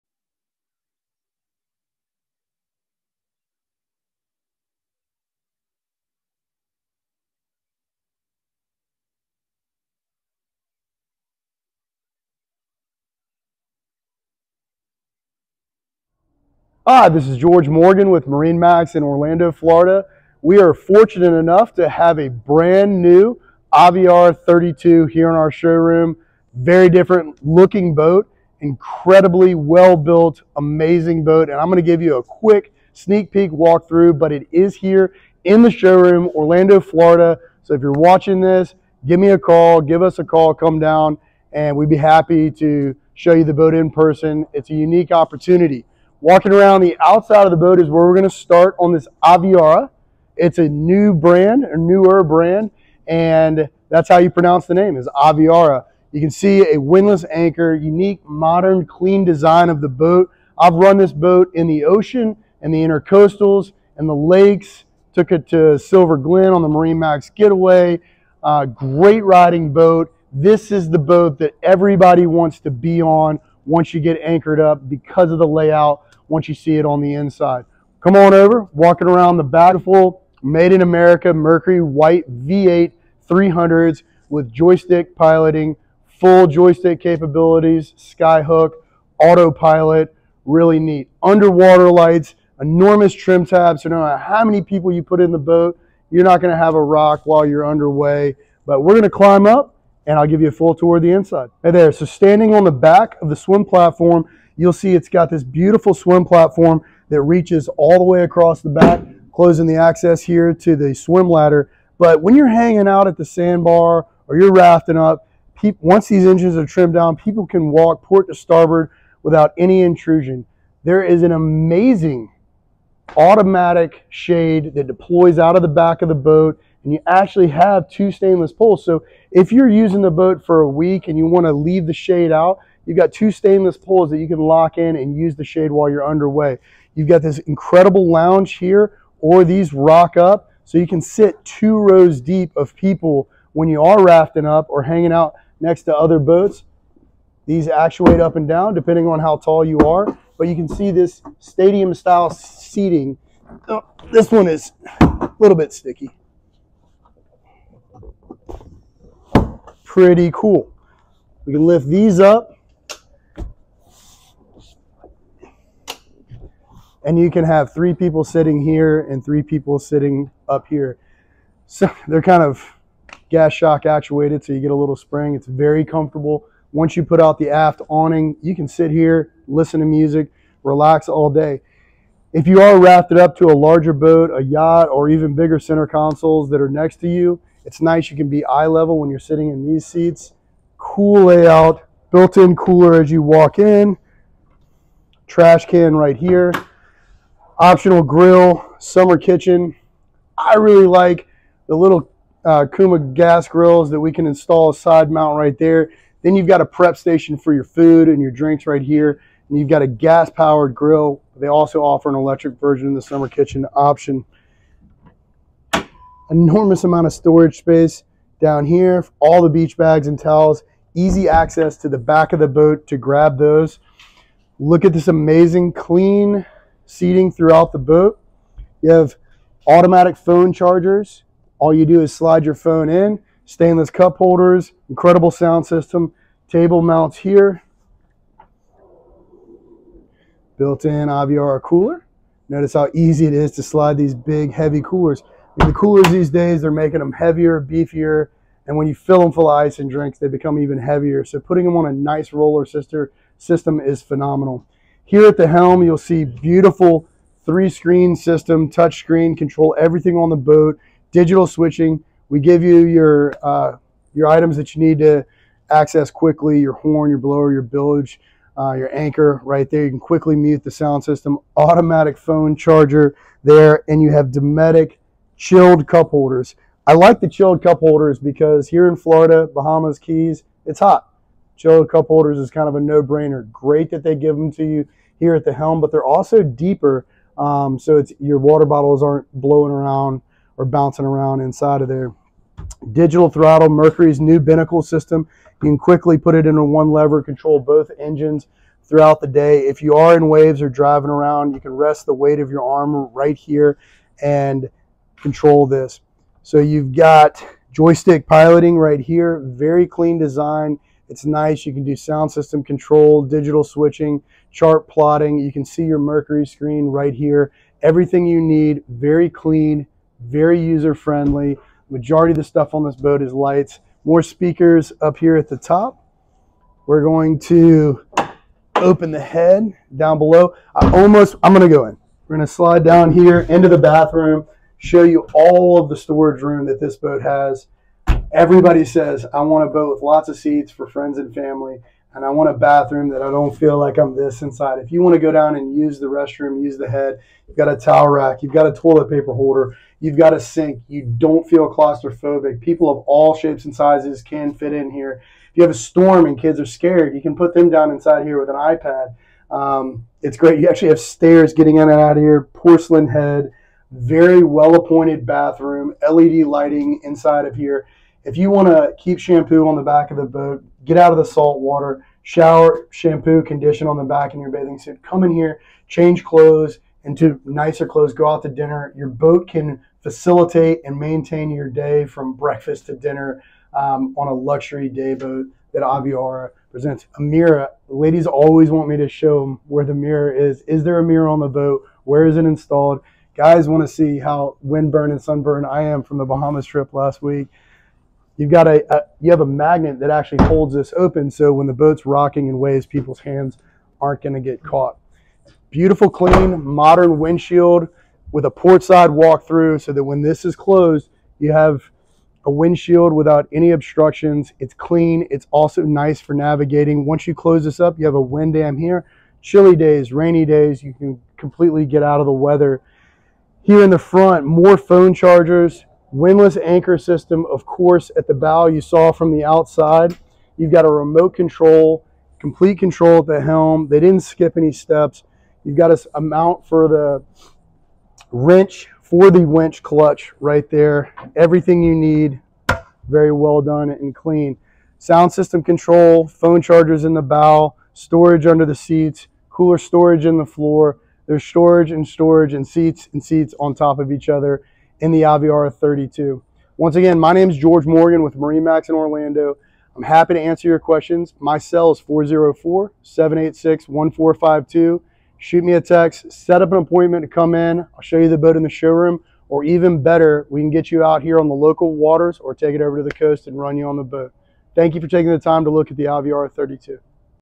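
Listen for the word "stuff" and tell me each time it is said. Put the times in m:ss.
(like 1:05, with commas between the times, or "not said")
5:22.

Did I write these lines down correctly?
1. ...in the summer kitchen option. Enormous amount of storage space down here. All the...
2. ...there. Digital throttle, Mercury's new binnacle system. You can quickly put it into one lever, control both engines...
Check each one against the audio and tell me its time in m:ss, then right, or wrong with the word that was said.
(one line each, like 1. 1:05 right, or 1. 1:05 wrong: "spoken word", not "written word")
1. 3:32 right
2. 4:51 right.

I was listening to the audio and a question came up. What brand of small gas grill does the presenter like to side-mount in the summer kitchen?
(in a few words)
Kuuma.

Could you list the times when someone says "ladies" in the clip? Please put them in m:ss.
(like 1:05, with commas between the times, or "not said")
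6:27.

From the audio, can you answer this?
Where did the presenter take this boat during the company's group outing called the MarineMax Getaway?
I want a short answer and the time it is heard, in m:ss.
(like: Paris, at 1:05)
Silver Glen, at 1:05.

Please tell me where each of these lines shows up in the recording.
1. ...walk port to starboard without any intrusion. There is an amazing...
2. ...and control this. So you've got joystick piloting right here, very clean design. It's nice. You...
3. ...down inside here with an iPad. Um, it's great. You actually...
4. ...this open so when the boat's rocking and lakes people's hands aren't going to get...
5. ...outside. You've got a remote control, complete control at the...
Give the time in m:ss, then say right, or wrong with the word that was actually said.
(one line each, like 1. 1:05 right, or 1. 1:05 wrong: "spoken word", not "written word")
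1. 1:57 right
2. 5:04 right
3. 5:57 right
4. 6:40 wrong: "waves", not "lakes"
5. 7:09 right.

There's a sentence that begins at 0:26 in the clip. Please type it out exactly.
Very different looking boat, incredibly well built, amazing boat.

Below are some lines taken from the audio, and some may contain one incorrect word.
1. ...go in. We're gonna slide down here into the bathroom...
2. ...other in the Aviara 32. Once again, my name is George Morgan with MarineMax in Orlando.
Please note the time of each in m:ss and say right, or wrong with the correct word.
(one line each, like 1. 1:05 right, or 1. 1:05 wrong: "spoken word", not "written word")
1. 5:31 right
2. 7:34 right.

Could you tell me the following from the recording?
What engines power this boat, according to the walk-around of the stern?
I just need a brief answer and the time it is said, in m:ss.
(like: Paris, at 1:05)
Mercury white V8 300s, at 1:21.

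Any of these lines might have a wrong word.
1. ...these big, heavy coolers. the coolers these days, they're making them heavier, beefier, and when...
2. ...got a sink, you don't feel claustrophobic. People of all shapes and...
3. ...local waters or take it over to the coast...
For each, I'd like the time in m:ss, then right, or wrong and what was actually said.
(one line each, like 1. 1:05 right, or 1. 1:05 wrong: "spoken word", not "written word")
1. 4:03 right
2. 5:50 right
3. 7:51 right.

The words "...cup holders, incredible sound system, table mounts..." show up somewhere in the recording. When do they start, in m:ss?
3:53.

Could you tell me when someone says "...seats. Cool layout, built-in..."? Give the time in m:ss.
3:09.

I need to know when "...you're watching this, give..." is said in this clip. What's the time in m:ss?
0:37.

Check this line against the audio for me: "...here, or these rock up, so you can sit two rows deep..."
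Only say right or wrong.
right.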